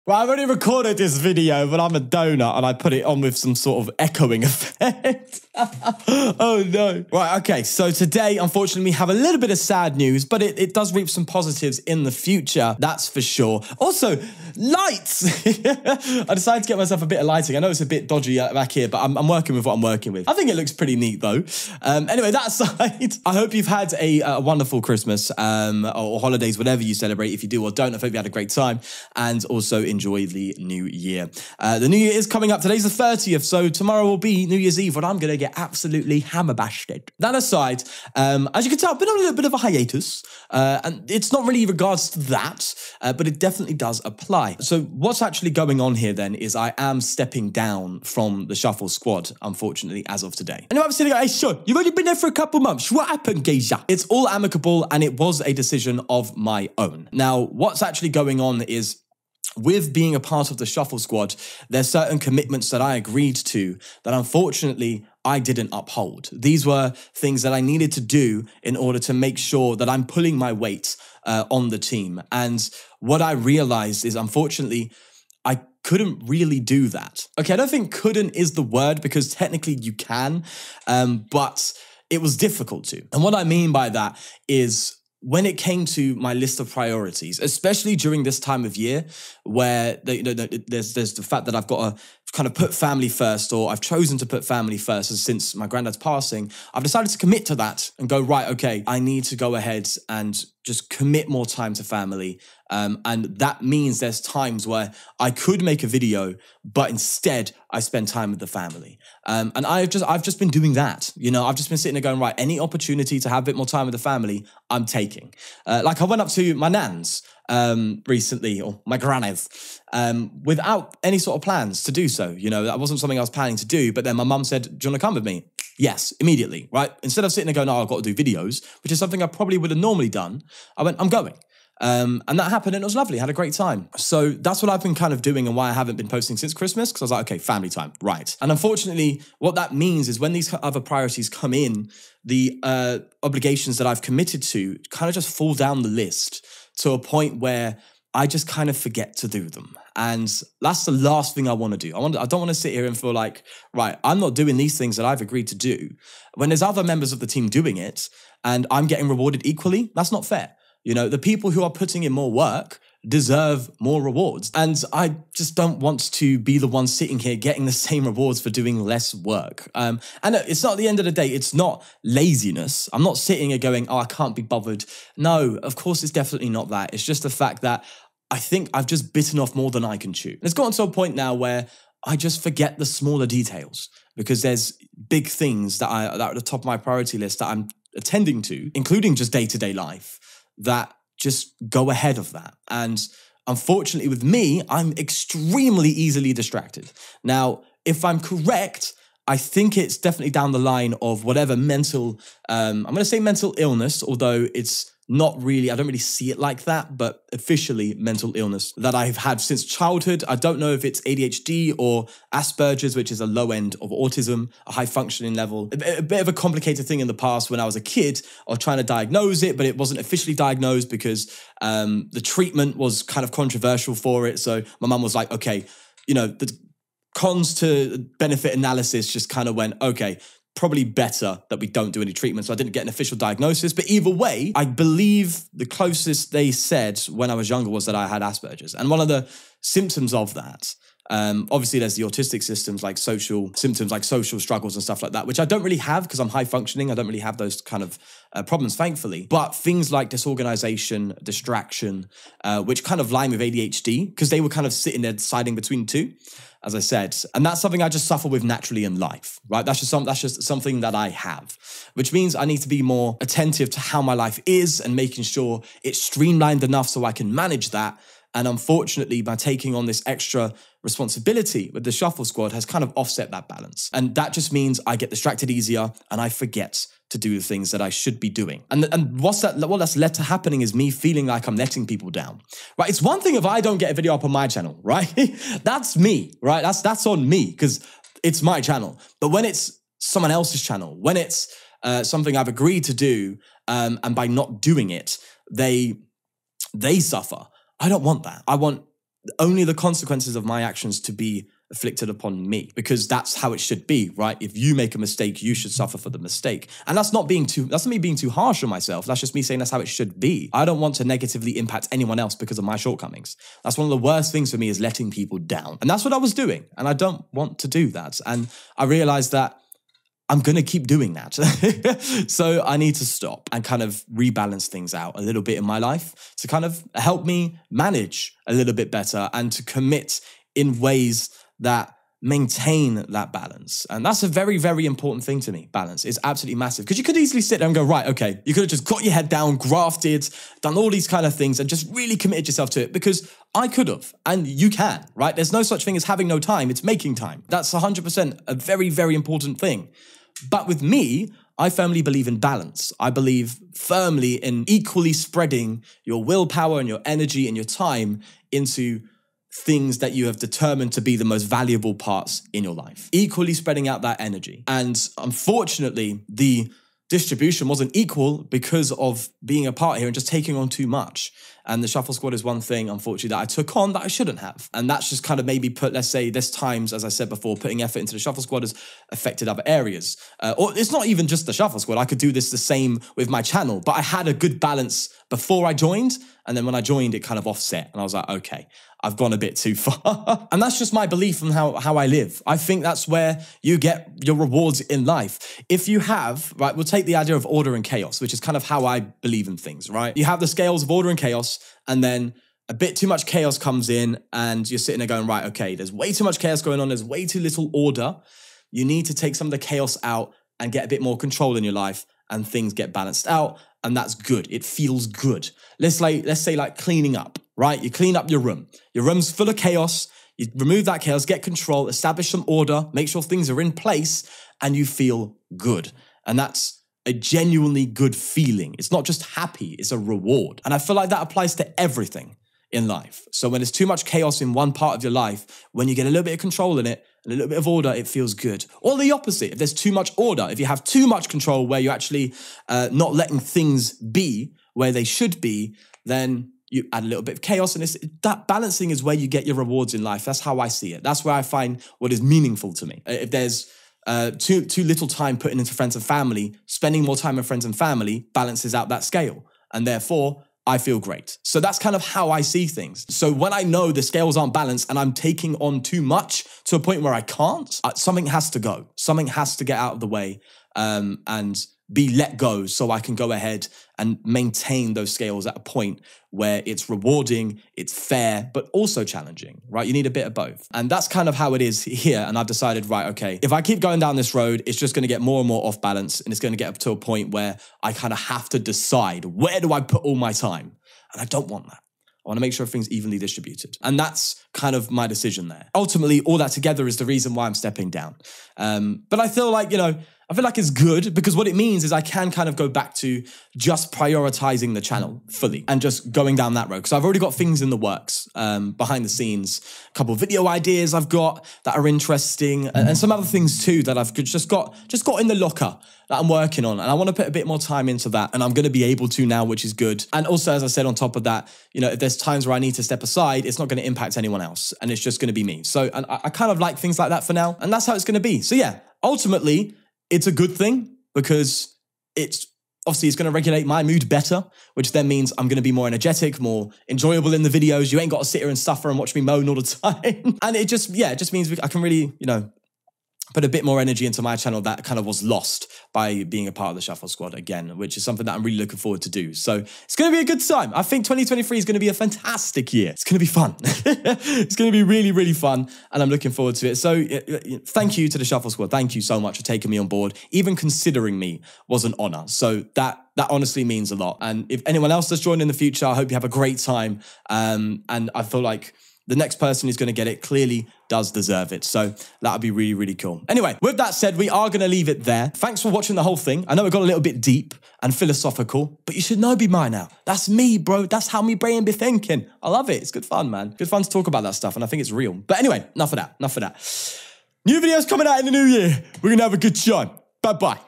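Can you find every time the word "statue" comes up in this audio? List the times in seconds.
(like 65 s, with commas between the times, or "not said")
not said.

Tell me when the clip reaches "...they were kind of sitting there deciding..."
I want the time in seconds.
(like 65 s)
254 s.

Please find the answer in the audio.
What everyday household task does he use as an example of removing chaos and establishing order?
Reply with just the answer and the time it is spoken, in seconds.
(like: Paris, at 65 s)
Cleaning up, at 416 s.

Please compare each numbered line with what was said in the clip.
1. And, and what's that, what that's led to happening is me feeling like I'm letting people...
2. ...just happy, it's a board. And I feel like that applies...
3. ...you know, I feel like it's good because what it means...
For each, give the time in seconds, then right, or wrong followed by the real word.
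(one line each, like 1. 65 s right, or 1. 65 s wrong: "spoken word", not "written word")
1. 278 s right
2. 429 s wrong: "reward", not "board"
3. 499 s right.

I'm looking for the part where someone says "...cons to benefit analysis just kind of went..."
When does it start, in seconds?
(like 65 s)
227 s.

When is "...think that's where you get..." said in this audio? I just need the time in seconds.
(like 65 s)
392 s.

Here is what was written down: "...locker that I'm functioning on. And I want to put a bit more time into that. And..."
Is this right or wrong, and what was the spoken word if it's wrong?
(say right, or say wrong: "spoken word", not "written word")
wrong: "working", not "functioning".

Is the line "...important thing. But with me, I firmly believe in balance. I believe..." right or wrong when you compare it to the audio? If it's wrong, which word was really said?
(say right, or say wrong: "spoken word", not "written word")
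right.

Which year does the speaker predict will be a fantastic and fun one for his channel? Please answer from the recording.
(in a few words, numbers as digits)
2023.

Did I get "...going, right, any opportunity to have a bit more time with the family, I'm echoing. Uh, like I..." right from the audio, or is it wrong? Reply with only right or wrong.
wrong.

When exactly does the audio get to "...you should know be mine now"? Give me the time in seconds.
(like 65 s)
578 s.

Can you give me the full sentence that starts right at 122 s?
You know, that wasn't something I was planning to do.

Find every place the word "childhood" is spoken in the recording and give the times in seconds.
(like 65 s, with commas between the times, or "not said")
209 s.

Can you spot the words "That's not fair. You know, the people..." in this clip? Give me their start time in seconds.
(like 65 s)
159 s.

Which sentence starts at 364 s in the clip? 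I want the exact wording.
And unfortunately, the distribution wasn't equal because of being a part here and just taking on too much.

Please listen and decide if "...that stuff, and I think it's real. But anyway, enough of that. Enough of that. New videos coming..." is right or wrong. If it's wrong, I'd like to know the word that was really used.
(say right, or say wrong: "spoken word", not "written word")
right.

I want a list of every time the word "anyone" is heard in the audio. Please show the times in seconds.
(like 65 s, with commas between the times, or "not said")
311 s, 524 s, 564 s.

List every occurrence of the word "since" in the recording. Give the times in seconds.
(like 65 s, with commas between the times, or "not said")
95 s, 136 s, 209 s.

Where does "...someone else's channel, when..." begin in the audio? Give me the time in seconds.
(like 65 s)
289 s.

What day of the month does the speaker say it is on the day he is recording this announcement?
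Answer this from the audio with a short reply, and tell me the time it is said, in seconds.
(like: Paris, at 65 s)
30th, at 33 s.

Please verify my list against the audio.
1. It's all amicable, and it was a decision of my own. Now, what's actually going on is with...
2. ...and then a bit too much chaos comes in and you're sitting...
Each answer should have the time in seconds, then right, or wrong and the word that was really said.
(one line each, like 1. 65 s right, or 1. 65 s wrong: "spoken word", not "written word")
1. 53 s right
2. 401 s right.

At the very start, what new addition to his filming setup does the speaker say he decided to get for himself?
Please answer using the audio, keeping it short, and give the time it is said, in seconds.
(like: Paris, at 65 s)
Lighting, at 17 s.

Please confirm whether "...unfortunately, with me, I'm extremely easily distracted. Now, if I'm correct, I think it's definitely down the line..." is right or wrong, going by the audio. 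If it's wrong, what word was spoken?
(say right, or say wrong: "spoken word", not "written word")
right.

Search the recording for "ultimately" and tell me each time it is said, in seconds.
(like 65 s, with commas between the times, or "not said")
495 s, 529 s.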